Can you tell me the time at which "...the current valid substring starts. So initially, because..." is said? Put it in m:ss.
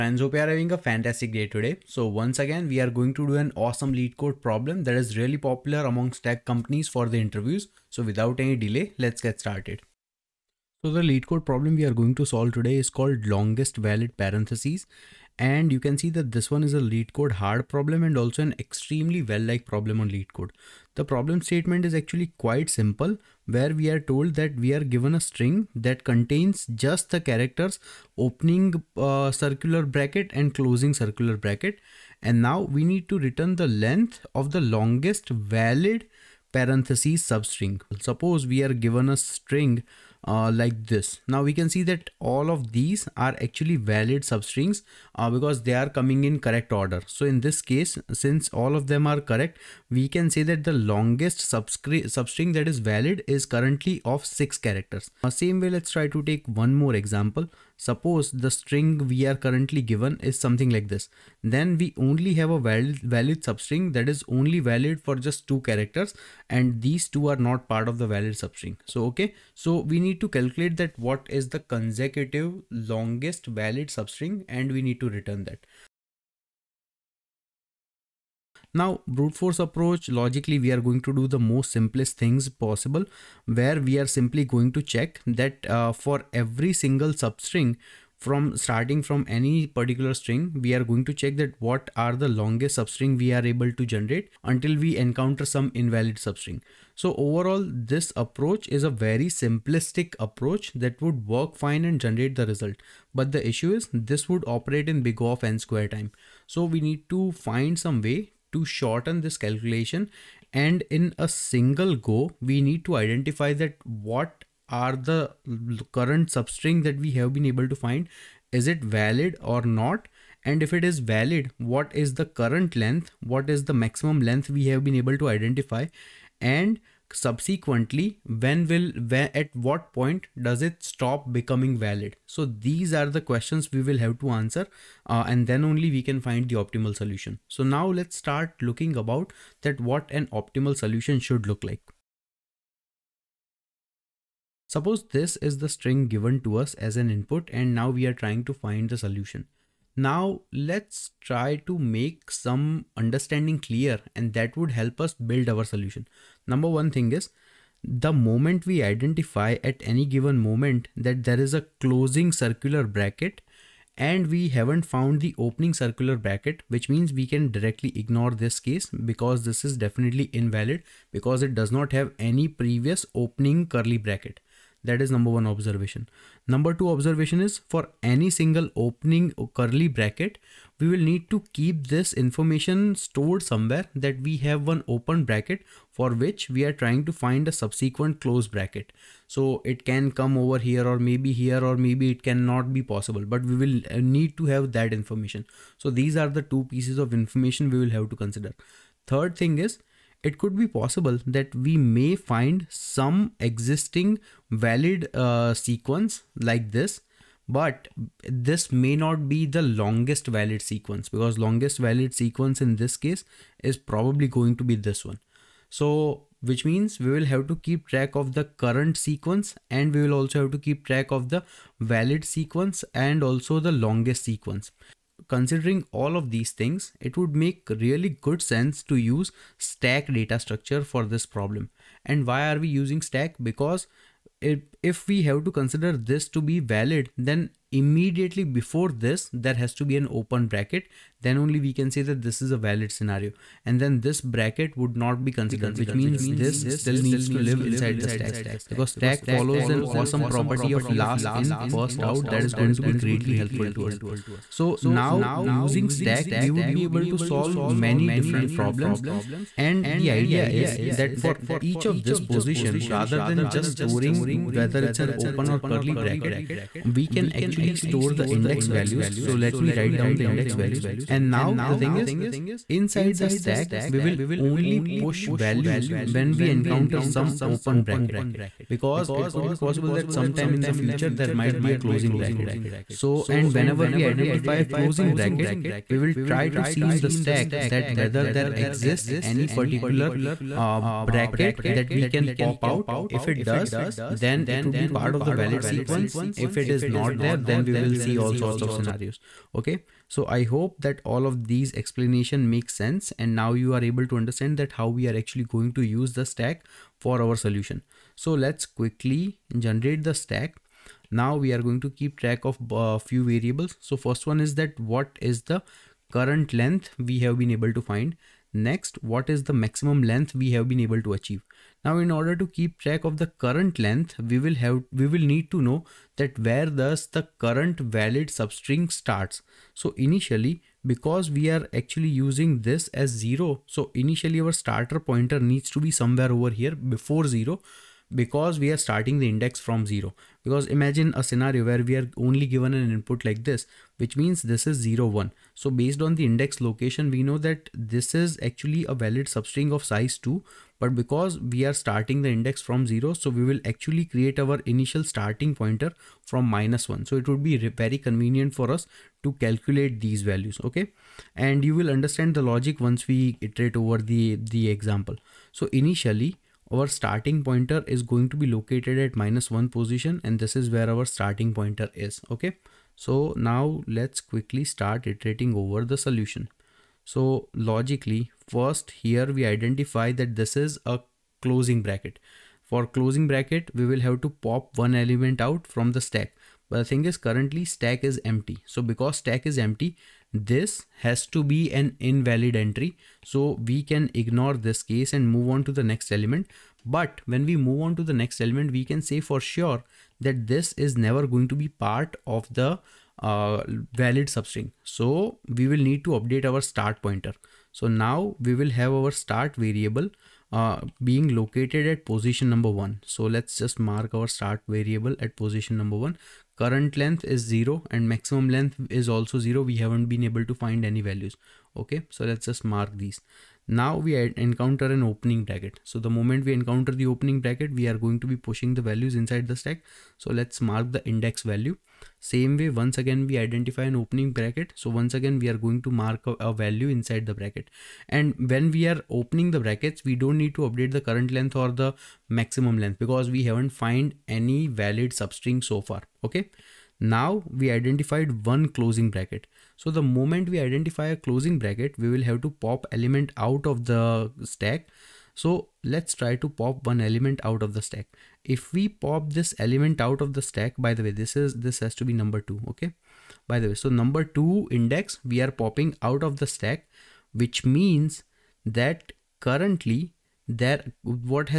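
5:27.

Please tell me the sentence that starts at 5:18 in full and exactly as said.
Next, what is the maximum length we have been able to achieve?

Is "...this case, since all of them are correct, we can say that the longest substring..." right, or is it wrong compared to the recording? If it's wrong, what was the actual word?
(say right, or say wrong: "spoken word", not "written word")
right.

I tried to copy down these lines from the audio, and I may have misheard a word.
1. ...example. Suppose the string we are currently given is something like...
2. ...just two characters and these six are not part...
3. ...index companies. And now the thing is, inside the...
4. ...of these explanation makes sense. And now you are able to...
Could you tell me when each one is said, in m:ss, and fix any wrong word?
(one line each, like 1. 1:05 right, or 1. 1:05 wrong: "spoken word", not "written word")
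1. 0:56 right
2. 1:05 wrong: "two", not "six"
3. 4:30 wrong: "values", not "companies"
4. 5:01 right.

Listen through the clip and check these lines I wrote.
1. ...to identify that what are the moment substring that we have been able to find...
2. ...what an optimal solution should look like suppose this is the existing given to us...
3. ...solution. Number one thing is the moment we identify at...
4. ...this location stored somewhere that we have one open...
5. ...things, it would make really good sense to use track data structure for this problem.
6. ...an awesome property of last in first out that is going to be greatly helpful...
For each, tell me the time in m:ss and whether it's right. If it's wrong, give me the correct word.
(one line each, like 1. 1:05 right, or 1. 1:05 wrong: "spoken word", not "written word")
1. 1:52 wrong: "current", not "moment"
2. 2:19 wrong: "string", not "existing"
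3. 2:35 right
4. 3:01 wrong: "information", not "location"
5. 3:46 wrong: "stack", not "track"
6. 4:09 right.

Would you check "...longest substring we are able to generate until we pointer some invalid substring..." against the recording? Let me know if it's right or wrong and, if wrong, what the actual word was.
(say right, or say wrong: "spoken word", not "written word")
wrong: "encounter", not "pointer".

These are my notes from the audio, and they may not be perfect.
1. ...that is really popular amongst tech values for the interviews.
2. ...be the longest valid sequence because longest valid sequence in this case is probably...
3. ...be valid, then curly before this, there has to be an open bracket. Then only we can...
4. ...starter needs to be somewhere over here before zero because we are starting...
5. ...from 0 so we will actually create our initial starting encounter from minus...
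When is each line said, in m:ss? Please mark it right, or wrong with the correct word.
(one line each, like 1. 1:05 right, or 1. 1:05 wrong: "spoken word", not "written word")
1. 0:04 wrong: "companies", not "values"
2. 3:29 right
3. 3:56 wrong: "immediately", not "curly"
4. 5:34 wrong: "pointer", not "starter"
5. 5:52 wrong: "pointer", not "encounter".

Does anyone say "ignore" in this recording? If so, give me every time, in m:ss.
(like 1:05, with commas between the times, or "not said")
2:47, 6:34.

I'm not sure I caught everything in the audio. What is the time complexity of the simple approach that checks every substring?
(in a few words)
O(n^2).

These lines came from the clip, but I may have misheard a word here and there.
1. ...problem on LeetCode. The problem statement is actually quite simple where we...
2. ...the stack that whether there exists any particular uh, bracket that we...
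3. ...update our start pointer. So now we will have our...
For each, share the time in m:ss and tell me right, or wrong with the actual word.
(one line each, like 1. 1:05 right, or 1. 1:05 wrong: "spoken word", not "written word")
1. 0:19 right
2. 4:46 right
3. 6:46 right.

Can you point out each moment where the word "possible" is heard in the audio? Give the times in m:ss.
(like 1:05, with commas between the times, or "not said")
1:22, 3:12, 3:20, 4:39.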